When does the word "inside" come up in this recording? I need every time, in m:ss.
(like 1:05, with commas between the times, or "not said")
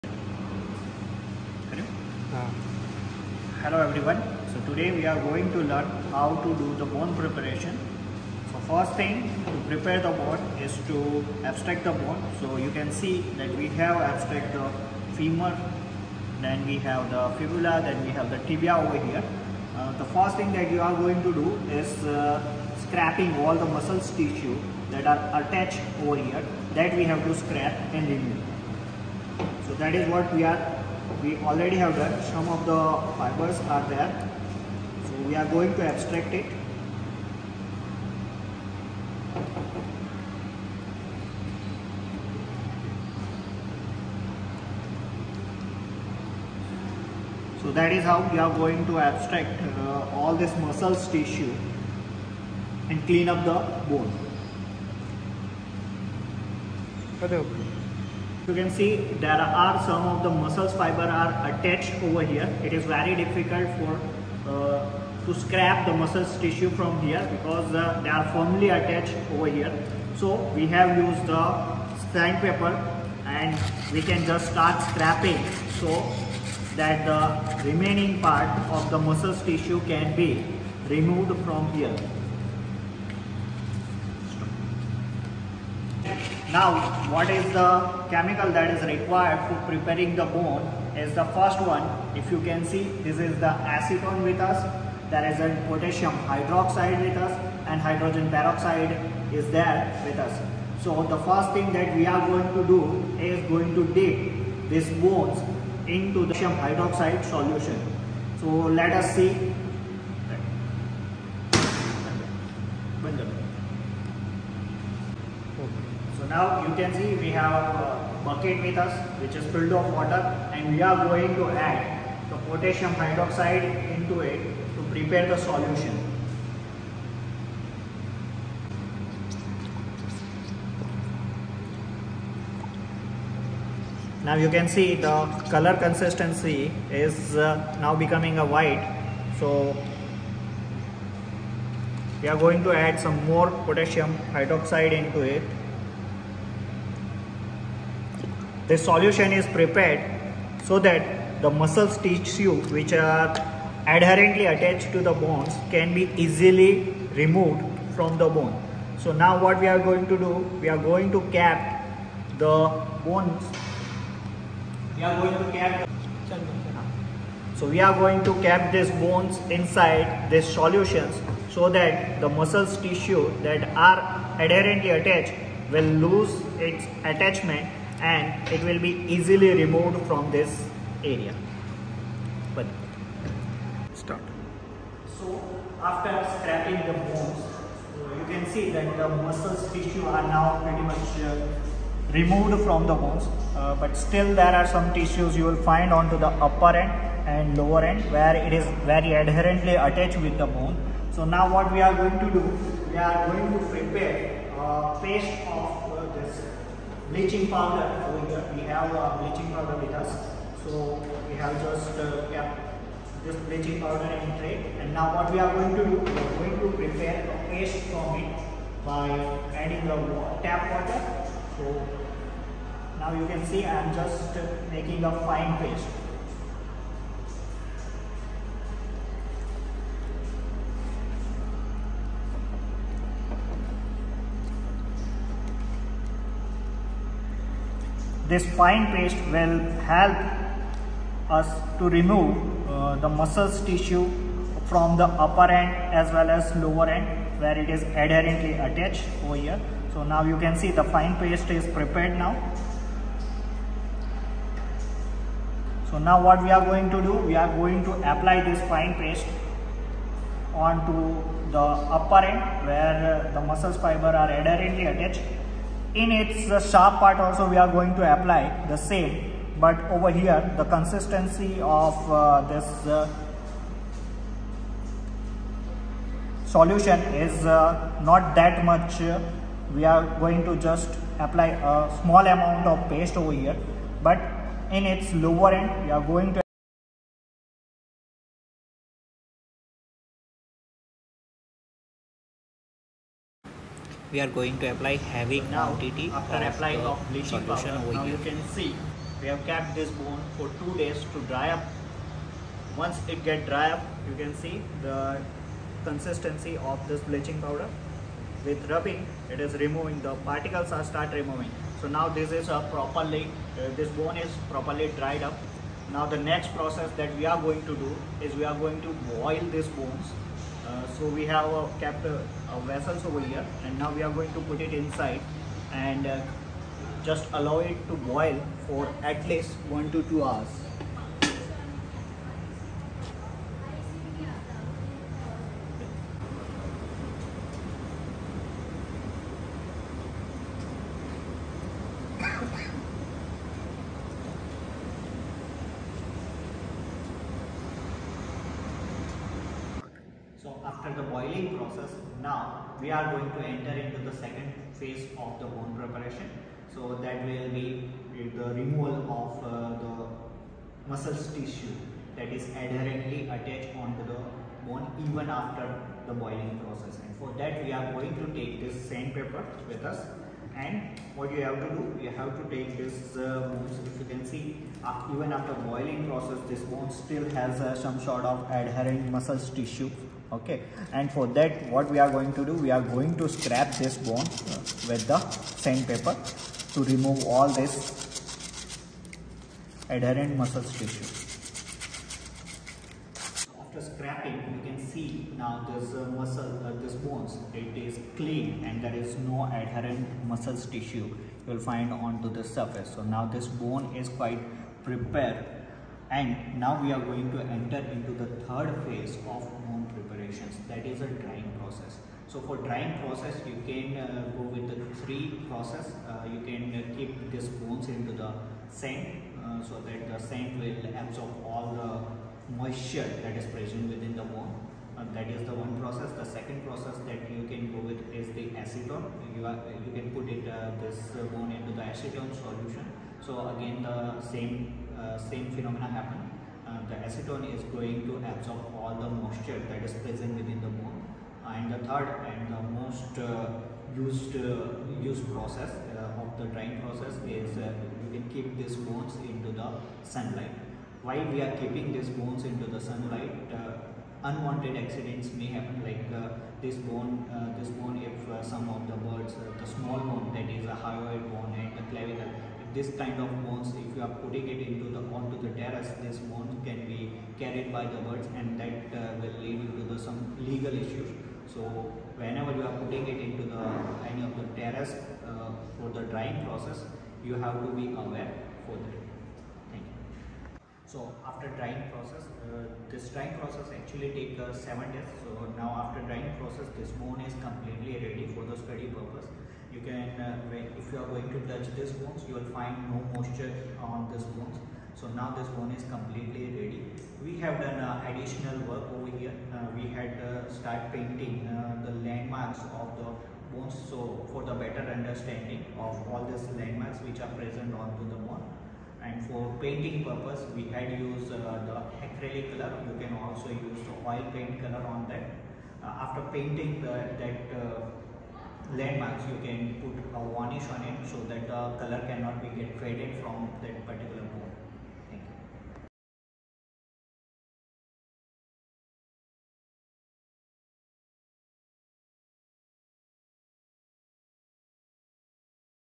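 2:49, 5:24.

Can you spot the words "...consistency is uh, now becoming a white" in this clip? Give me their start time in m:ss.
2:15.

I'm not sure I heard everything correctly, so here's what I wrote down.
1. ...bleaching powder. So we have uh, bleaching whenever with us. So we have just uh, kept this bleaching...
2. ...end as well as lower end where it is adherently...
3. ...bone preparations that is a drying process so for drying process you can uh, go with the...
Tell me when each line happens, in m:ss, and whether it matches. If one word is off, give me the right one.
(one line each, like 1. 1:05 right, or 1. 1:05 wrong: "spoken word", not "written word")
1. 3:27 wrong: "powder", not "whenever"
2. 4:05 right
3. 6:49 right.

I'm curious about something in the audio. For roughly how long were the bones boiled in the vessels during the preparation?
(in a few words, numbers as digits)
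1 to 2 hours.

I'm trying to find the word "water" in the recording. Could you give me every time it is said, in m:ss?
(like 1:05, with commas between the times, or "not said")
1:59, 3:40.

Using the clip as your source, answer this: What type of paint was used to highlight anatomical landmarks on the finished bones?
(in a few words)
Acrylic.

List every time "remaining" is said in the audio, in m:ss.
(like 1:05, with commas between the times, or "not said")
1:17.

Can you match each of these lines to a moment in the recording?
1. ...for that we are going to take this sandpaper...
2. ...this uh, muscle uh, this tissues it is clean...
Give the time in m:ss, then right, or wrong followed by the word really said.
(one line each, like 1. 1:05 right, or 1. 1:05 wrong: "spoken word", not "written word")
1. 6:07 right
2. 6:35 wrong: "bones", not "tissues".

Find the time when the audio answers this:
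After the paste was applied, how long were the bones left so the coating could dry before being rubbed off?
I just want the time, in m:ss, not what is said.
5:00.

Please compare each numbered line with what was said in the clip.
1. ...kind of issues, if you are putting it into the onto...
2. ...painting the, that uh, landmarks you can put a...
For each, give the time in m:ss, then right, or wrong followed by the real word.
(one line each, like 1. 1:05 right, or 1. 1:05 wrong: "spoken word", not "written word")
1. 7:42 wrong: "bones", not "issues"
2. 8:36 right.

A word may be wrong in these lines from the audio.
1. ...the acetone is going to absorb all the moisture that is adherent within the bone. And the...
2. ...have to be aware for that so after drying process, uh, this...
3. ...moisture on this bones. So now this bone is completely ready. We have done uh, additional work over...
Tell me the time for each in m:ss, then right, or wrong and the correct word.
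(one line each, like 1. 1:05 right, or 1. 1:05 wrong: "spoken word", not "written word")
1. 7:16 wrong: "present", not "adherent"
2. 7:57 right
3. 8:13 right.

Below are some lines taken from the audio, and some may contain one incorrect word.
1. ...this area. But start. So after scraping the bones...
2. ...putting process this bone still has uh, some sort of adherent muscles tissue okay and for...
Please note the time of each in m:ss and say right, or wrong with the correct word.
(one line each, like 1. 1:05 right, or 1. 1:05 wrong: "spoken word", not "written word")
1. 3:00 right
2. 6:15 wrong: "boiling", not "putting".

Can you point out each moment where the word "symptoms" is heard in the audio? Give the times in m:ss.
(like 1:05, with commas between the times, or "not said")
not said.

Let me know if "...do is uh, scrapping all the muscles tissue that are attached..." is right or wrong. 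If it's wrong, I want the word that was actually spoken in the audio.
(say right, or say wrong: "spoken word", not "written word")
right.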